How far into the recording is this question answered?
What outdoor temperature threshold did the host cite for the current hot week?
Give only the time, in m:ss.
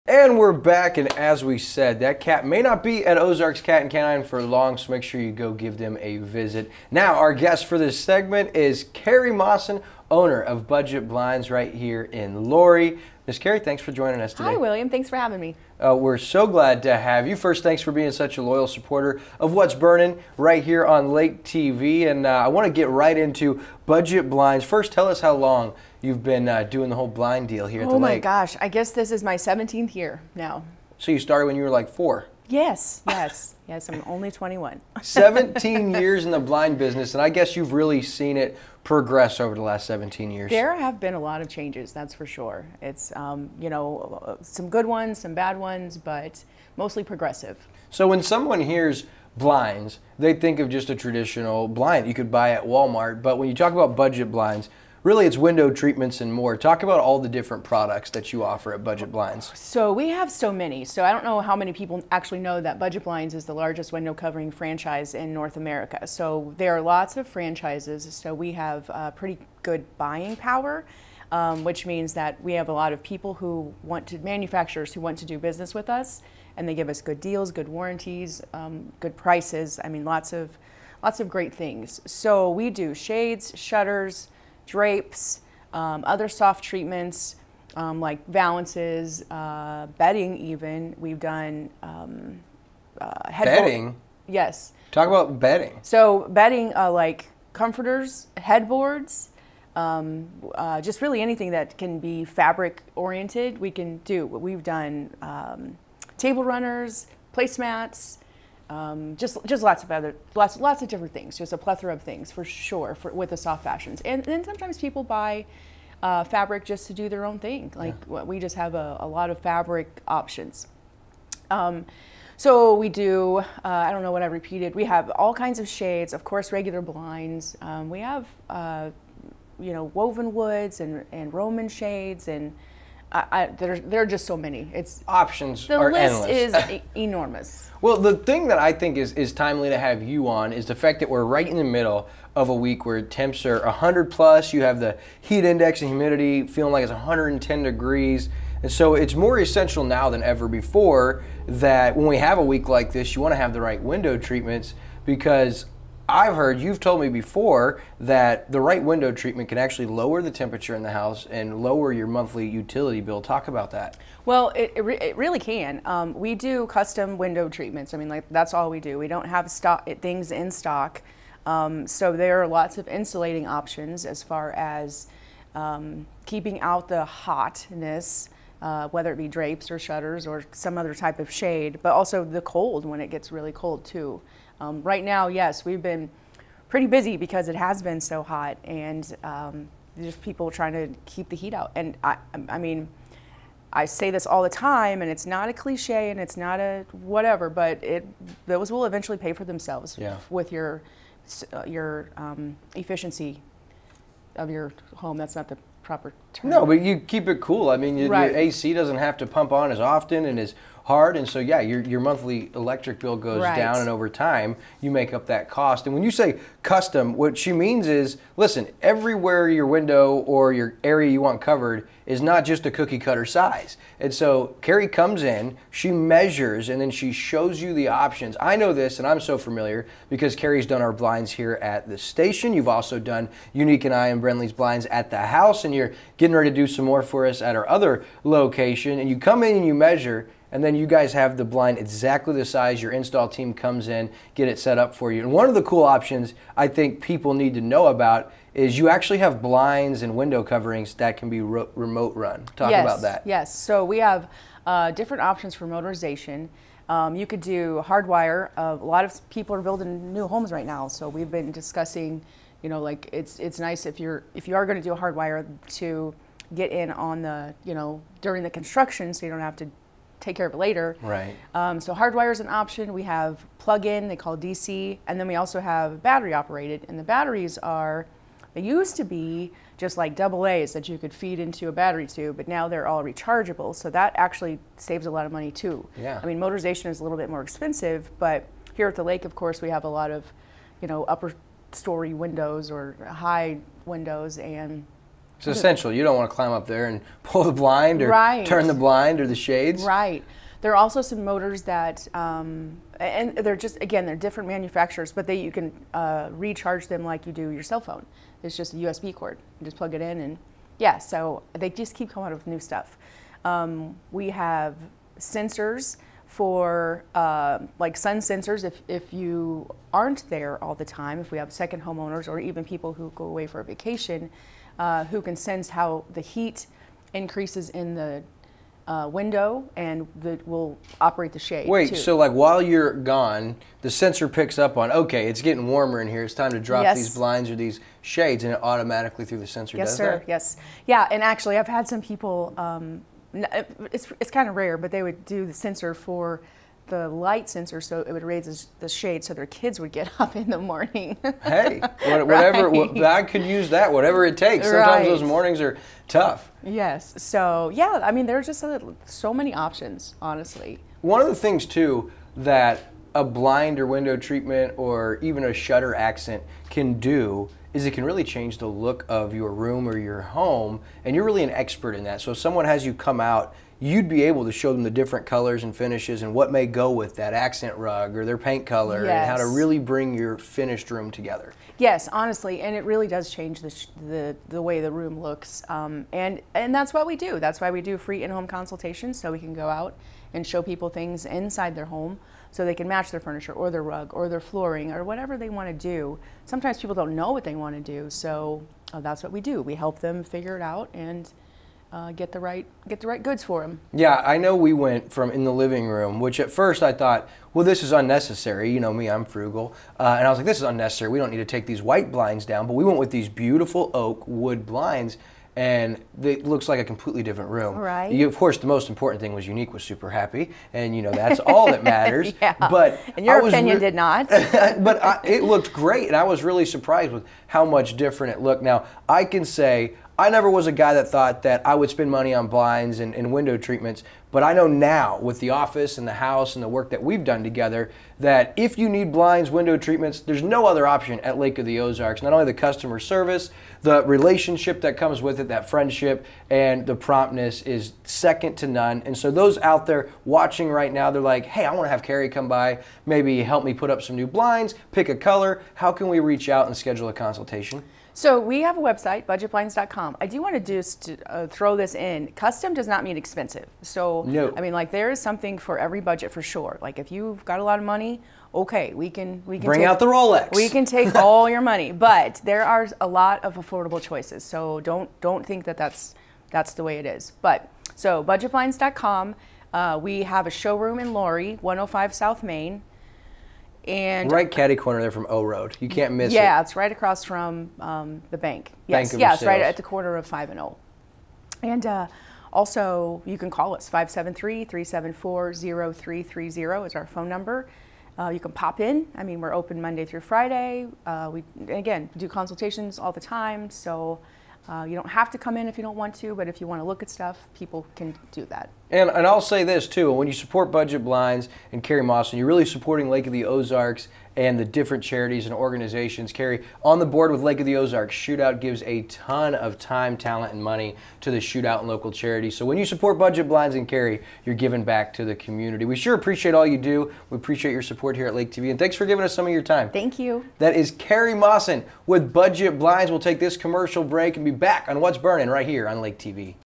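2:23.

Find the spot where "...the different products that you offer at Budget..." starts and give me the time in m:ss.
0:57.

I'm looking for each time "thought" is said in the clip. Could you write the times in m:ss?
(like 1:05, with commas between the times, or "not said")
6:46, 7:11.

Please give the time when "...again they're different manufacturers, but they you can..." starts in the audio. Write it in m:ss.
5:03.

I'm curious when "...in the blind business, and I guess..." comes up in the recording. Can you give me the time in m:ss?
0:36.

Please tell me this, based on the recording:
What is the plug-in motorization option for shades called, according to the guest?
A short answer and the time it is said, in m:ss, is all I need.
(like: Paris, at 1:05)
DC, at 4:34.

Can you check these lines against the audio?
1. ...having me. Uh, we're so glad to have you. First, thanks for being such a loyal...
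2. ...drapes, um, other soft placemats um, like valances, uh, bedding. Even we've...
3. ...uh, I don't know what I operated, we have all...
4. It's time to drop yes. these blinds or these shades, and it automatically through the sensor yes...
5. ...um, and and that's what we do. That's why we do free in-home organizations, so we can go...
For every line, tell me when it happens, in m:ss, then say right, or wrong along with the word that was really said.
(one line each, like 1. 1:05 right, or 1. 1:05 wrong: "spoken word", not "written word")
1. 0:15 right
2. 1:24 wrong: "treatments", not "placemats"
3. 2:03 wrong: "repeated", not "operated"
4. 5:36 right
5. 6:25 wrong: "consultations", not "organizations".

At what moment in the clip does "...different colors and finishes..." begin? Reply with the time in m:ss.
6:14.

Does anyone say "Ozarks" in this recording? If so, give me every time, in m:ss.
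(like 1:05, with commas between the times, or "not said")
0:03, 7:21, 8:33, 8:37.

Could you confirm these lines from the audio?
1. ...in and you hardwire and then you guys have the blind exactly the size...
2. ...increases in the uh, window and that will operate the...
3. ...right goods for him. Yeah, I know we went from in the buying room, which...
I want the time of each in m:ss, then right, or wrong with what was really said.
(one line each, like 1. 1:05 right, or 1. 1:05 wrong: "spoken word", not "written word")
1. 3:59 wrong: "measure", not "hardwire"
2. 5:27 right
3. 6:43 wrong: "living", not "buying".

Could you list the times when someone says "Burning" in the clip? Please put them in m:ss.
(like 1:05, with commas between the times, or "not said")
0:19, 8:55.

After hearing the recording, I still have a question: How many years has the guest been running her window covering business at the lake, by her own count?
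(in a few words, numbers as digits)
17.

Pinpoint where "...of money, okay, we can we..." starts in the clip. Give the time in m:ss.
7:47.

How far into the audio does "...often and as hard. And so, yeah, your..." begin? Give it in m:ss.
3:29.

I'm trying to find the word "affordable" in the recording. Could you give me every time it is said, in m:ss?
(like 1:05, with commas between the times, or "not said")
7:53.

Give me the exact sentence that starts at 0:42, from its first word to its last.
It's, um, you know, some good ones, some bad ones, but mostly progressive.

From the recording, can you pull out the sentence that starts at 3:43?
And so, Karie comes in, she measures, and then she shows you the options.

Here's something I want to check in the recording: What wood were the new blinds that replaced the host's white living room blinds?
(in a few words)
oak.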